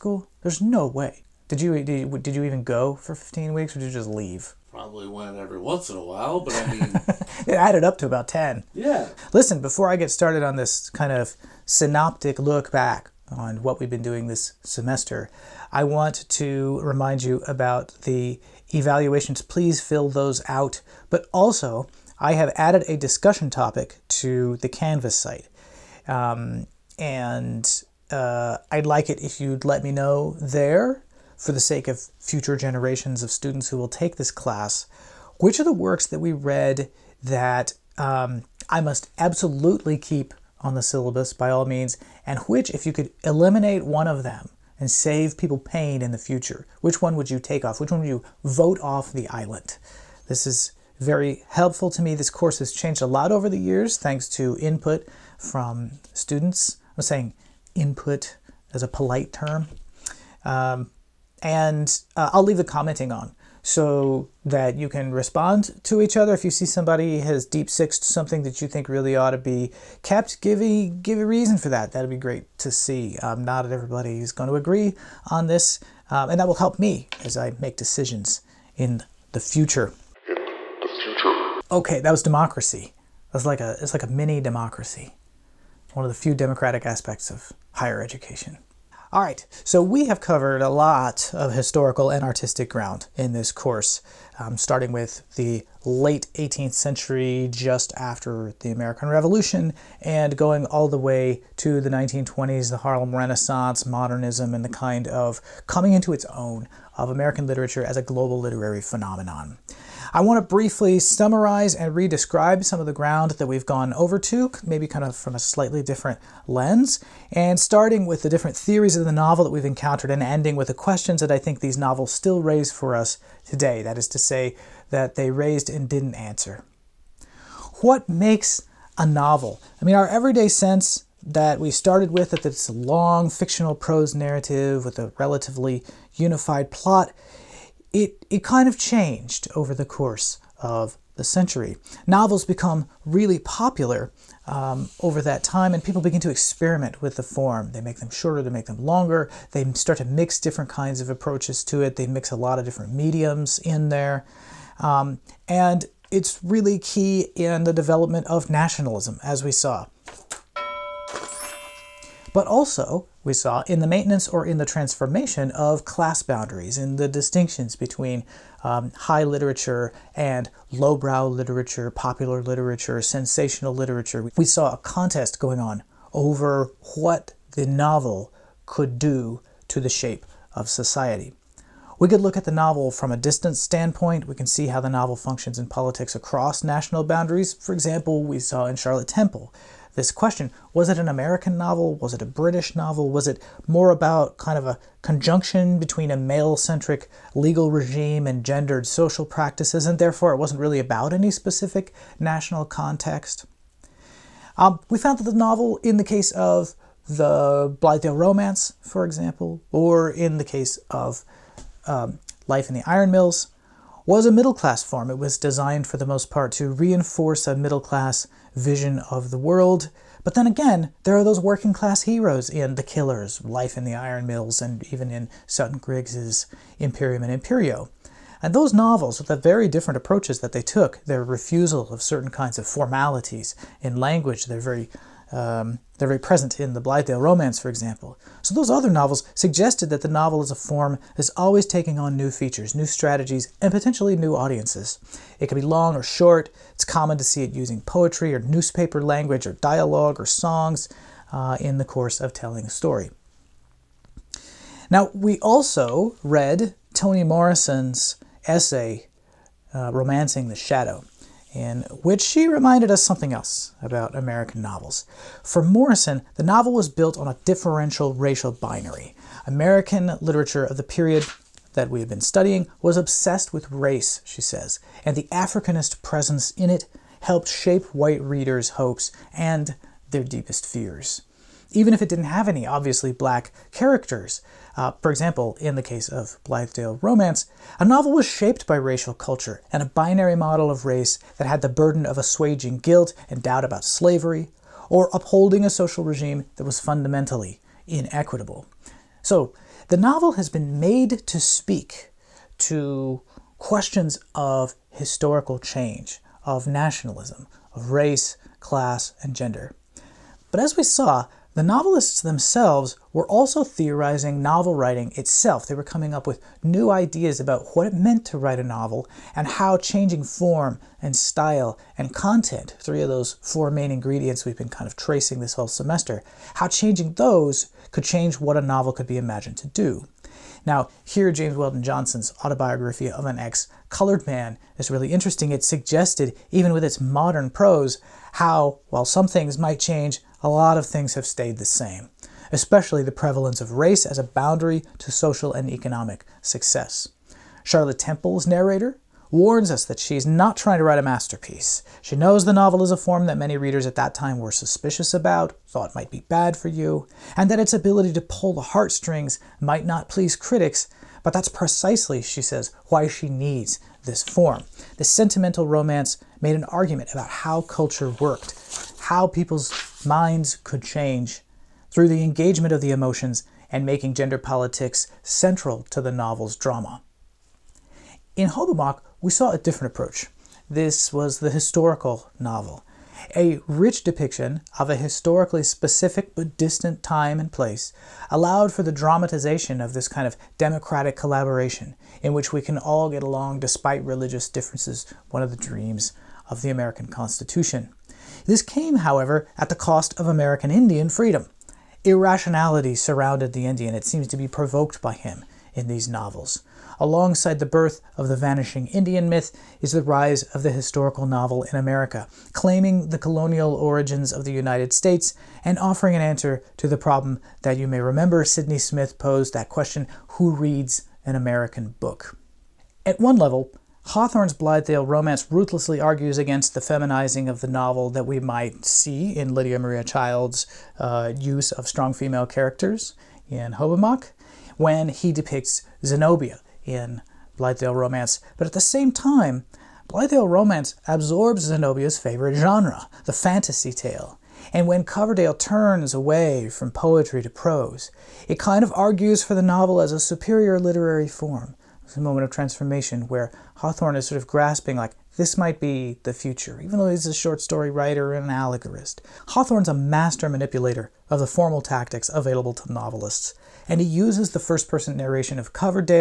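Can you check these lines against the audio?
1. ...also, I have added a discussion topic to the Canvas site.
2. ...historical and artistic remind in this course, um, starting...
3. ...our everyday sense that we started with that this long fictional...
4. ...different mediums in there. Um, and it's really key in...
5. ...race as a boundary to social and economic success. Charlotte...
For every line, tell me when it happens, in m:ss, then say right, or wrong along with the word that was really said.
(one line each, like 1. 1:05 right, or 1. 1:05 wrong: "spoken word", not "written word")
1. 0:21 right
2. 1:31 wrong: "ground", not "remind"
3. 2:09 right
4. 2:32 right
5. 5:43 right.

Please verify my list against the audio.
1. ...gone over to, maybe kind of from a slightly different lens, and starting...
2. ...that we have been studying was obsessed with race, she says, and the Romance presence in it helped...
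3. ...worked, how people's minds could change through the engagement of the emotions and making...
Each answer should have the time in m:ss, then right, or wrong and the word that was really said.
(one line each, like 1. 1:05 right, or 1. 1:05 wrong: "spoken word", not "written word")
1. 1:53 right
2. 4:31 wrong: "Africanist", not "Romance"
3. 6:08 right.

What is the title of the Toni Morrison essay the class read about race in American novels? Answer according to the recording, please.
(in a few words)
Romancing the Shadow.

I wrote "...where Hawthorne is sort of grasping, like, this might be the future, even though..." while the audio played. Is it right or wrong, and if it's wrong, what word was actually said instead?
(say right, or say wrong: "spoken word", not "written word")
right.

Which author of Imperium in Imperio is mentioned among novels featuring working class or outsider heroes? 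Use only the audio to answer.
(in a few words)
Sutton Griggs.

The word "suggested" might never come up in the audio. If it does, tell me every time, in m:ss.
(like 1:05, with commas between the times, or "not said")
3:59, 5:35.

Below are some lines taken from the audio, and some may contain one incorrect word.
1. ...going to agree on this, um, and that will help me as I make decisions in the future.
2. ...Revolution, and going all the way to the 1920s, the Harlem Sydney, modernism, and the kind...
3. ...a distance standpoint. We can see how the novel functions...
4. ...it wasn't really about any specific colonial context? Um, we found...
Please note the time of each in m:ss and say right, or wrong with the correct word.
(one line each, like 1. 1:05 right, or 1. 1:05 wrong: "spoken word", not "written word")
1. 1:14 right
2. 1:39 wrong: "Renaissance", not "Sydney"
3. 3:03 right
4. 3:20 wrong: "national", not "colonial".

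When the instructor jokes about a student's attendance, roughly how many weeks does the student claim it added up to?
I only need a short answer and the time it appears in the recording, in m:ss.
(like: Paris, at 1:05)
10, at 0:08.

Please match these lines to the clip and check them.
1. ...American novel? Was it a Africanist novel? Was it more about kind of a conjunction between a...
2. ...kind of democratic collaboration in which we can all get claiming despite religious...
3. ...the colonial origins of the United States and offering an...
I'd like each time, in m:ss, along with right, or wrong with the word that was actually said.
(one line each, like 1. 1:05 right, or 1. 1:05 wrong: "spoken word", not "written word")
1. 3:11 wrong: "British", not "Africanist"
2. 6:30 wrong: "along", not "claiming"
3. 6:53 right.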